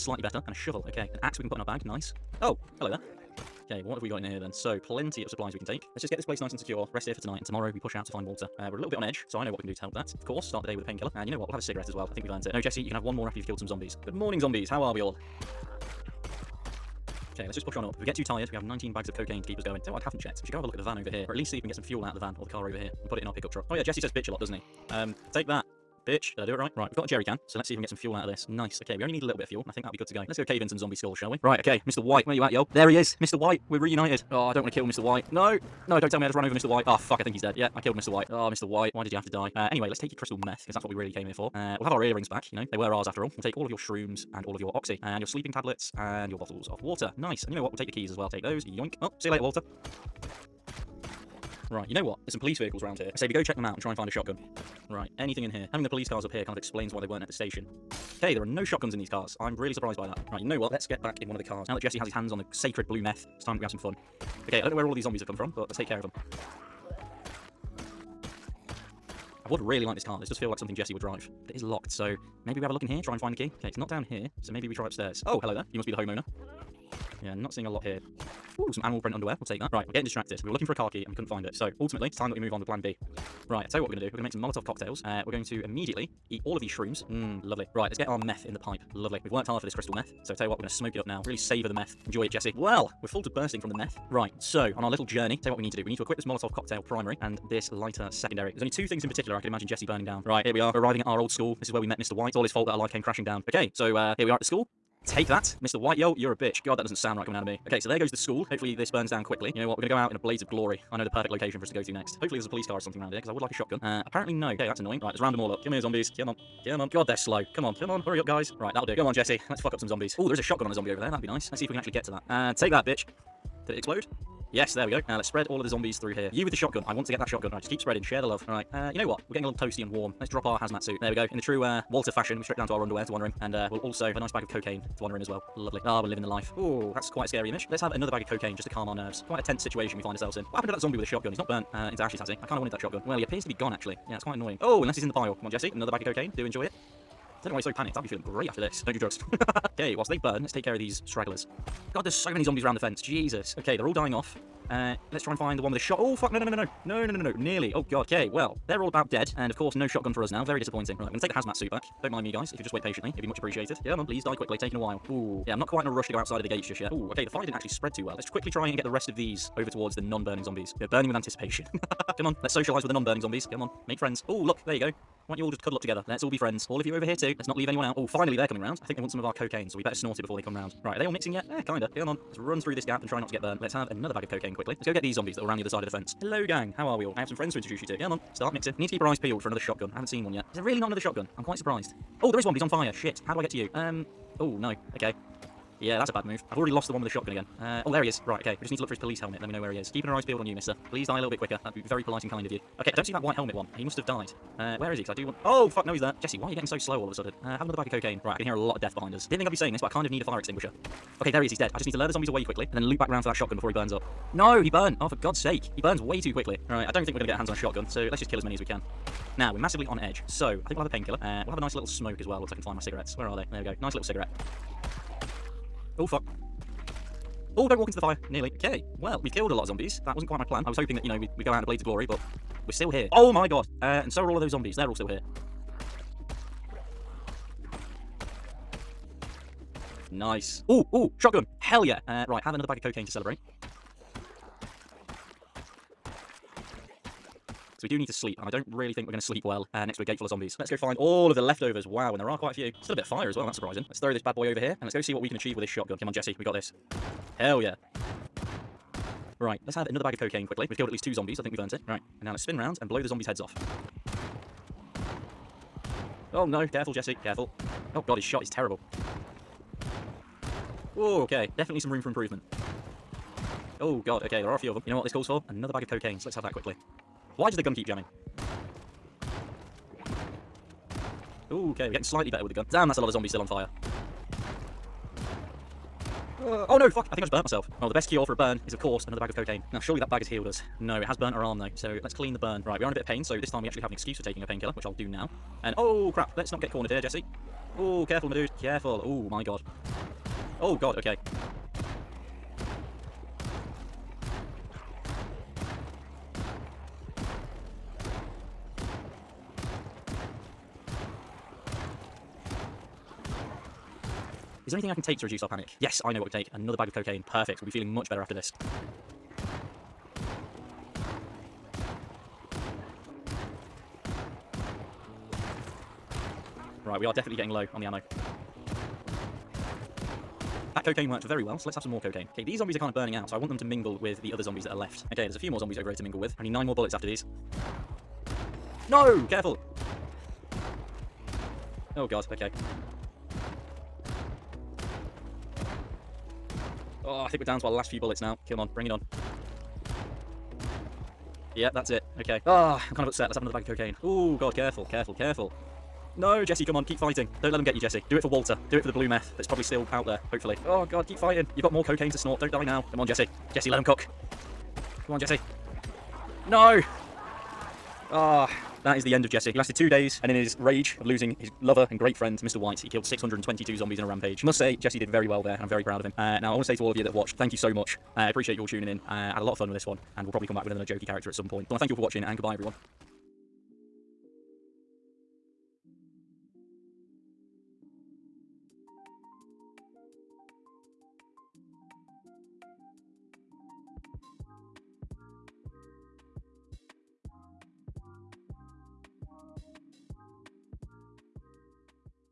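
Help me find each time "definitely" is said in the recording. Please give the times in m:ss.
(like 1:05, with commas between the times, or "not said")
4:31, 5:27.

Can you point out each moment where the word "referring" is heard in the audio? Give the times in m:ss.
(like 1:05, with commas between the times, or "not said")
not said.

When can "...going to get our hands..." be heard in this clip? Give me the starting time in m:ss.
3:37.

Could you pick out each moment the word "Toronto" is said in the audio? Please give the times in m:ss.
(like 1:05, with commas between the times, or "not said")
not said.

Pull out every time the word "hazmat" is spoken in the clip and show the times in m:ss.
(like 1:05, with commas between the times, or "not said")
2:10, 2:41.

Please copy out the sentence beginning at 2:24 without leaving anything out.
Oh, unless he's in the pile.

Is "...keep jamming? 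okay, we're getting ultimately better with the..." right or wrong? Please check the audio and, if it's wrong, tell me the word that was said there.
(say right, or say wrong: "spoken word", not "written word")
wrong: "slightly", not "ultimately".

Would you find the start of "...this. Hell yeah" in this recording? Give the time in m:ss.
4:16.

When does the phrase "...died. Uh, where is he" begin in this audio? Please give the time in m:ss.
3:24.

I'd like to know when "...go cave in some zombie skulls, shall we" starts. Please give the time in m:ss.
0:30.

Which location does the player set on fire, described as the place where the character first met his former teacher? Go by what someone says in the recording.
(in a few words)
old school.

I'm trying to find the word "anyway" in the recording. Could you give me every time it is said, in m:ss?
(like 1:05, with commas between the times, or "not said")
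0:39.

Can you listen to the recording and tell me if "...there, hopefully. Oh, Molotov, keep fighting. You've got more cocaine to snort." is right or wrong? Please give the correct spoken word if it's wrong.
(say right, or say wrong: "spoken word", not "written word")
wrong: "God", not "Molotov".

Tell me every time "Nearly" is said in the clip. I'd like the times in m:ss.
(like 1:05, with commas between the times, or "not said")
2:37, 3:48.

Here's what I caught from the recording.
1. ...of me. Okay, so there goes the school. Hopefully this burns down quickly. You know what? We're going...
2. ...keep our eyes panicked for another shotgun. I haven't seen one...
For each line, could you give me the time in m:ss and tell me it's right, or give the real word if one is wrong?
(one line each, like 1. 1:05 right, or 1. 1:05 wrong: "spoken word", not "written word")
1. 1:47 right
2. 3:08 wrong: "peeled", not "panicked".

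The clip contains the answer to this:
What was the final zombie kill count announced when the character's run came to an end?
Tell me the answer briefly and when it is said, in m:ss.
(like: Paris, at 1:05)
622, at 6:13.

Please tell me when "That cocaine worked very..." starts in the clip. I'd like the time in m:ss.
5:30.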